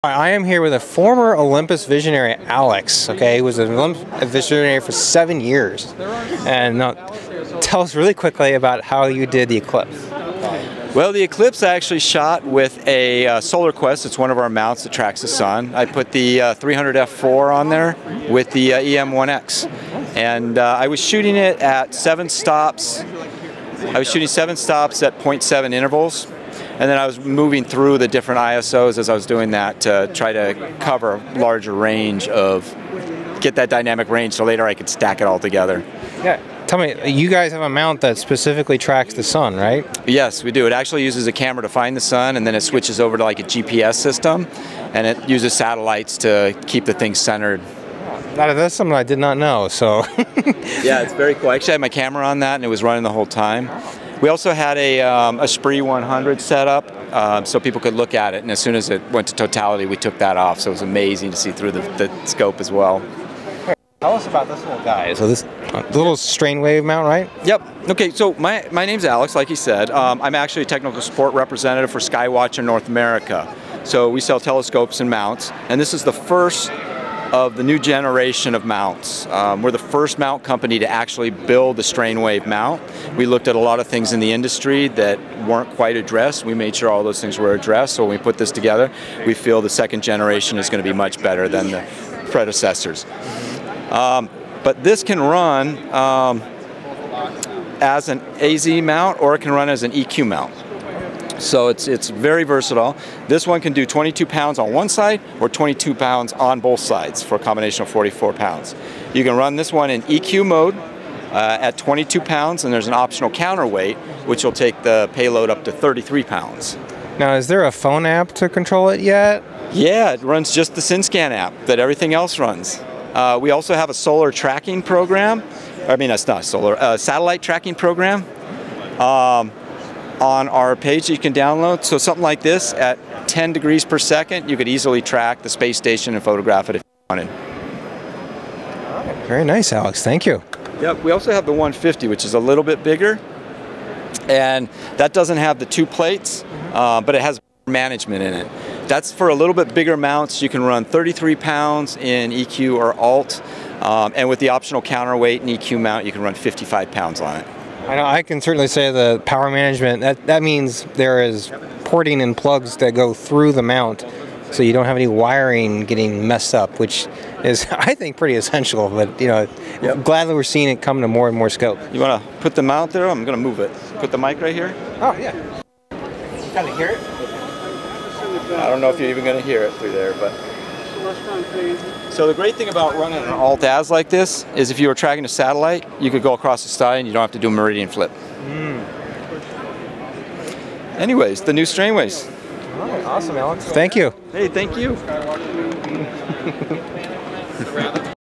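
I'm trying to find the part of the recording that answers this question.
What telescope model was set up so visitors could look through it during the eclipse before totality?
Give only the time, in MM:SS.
00:55.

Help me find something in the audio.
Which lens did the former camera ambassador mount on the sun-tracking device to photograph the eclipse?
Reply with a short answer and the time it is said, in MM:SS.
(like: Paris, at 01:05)
300F4, at 00:16.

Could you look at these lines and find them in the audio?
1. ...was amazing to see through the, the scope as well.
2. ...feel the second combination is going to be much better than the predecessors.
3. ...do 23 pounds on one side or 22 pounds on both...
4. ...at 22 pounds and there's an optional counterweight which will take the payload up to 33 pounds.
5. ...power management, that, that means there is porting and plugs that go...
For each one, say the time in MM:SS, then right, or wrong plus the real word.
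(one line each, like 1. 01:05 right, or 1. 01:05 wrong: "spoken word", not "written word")
1. 01:00 right
2. 01:29 wrong: "generation", not "combination"
3. 01:43 wrong: "22", not "23"
4. 01:51 right
5. 02:39 right.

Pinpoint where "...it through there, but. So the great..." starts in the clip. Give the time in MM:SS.
02:59.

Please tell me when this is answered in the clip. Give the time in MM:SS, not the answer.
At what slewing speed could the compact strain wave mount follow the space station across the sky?
02:13.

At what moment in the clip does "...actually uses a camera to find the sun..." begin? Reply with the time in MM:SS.
00:40.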